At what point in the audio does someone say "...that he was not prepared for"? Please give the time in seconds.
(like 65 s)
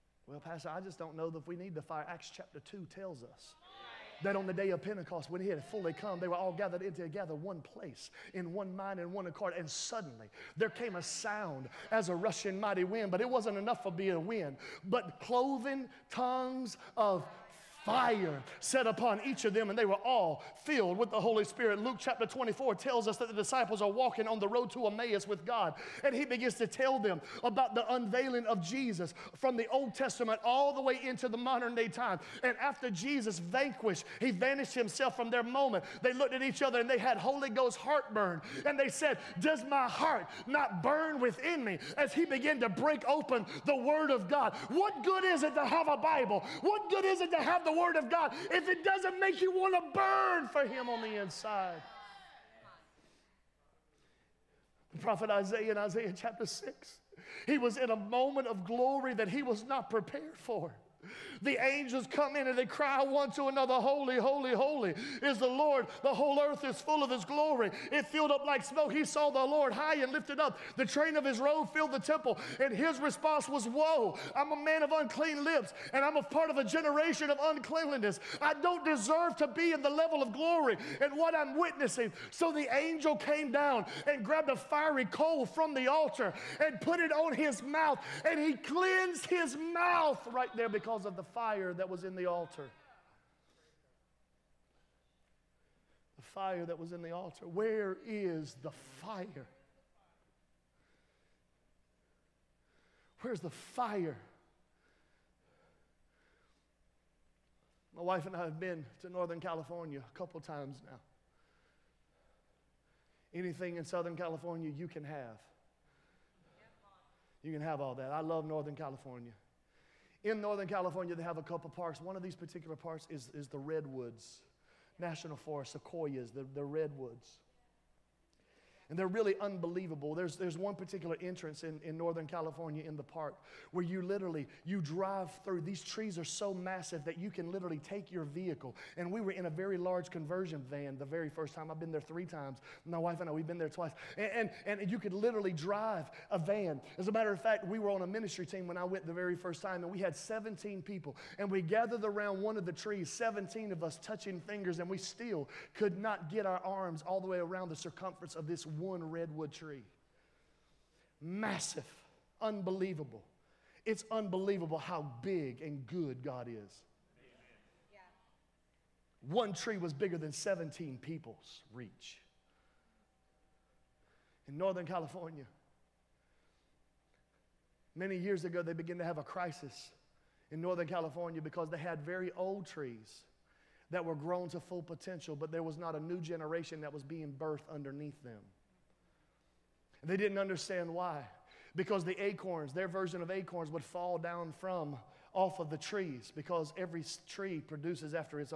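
59 s.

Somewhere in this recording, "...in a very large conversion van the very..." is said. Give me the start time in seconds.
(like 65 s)
139 s.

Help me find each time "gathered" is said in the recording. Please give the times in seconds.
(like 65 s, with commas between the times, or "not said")
6 s, 151 s.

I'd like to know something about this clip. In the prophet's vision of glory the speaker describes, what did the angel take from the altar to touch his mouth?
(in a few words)
A fiery coal.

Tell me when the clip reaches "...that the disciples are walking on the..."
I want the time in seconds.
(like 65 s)
23 s.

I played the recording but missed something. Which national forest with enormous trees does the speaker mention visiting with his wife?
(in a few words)
Redwoods National Forest.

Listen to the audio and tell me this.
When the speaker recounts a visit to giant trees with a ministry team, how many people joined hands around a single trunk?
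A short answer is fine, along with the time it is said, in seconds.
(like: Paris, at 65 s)
17, at 153 s.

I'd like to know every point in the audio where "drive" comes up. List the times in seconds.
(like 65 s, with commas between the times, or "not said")
134 s, 145 s.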